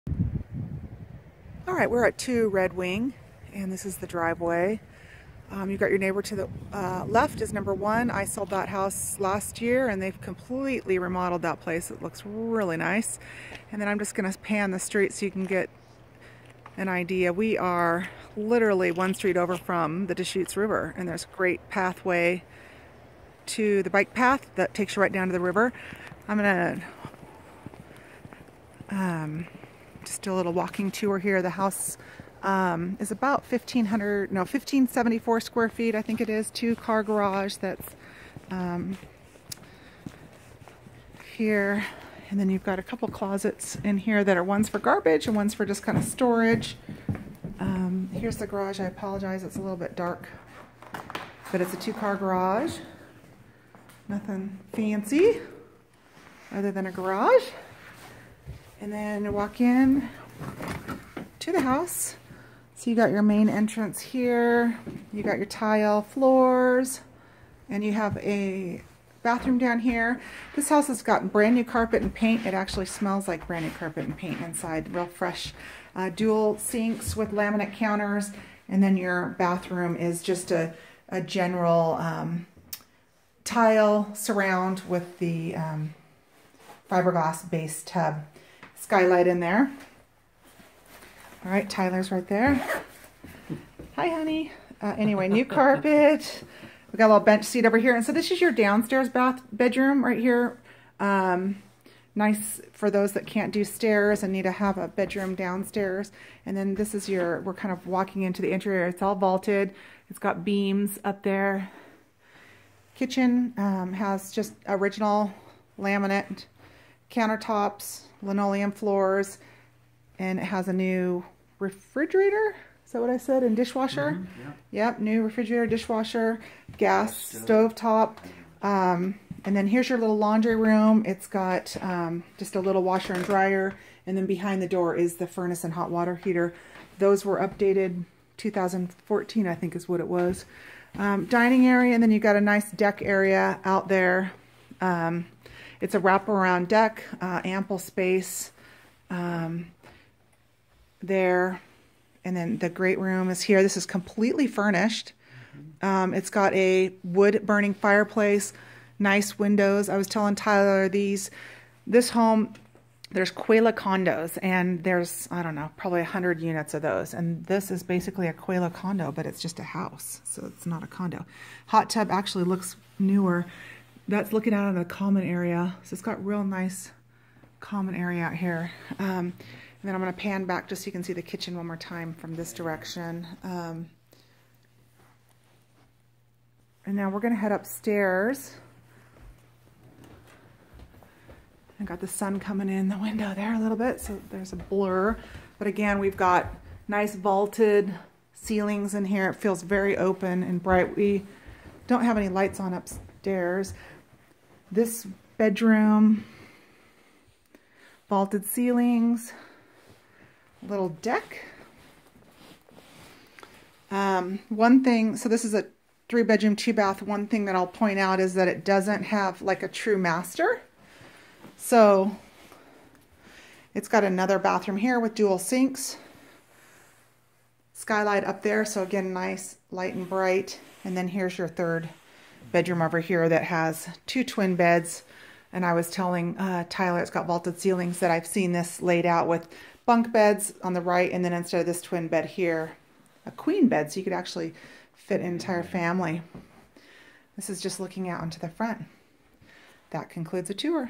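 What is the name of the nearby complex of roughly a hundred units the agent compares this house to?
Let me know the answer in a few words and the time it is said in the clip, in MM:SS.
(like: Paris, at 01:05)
Quelah condos, at 02:43.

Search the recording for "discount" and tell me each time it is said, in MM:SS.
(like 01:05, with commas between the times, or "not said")
not said.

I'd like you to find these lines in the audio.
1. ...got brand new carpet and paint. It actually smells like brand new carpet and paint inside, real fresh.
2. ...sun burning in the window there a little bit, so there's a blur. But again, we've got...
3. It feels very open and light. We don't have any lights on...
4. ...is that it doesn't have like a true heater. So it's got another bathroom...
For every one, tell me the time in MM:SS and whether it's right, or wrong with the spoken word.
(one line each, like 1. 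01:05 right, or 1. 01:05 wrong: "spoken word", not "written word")
1. 01:11 right
2. 03:12 wrong: "coming", not "burning"
3. 03:19 wrong: "bright", not "light"
4. 03:38 wrong: "master", not "heater".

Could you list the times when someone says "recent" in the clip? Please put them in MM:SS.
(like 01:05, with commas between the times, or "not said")
not said.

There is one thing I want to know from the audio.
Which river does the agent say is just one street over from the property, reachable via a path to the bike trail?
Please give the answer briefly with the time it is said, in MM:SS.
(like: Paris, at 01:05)
Deschutes River, at 00:20.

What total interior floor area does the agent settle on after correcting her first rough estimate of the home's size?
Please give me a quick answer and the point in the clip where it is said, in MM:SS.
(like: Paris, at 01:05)
1574 square feet, at 00:34.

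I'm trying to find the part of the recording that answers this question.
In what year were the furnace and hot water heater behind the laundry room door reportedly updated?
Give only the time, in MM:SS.
02:18.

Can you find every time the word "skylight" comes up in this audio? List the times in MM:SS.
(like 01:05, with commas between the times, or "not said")
01:28, 03:47.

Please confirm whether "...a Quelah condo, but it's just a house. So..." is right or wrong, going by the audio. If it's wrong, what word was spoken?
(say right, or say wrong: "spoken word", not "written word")
right.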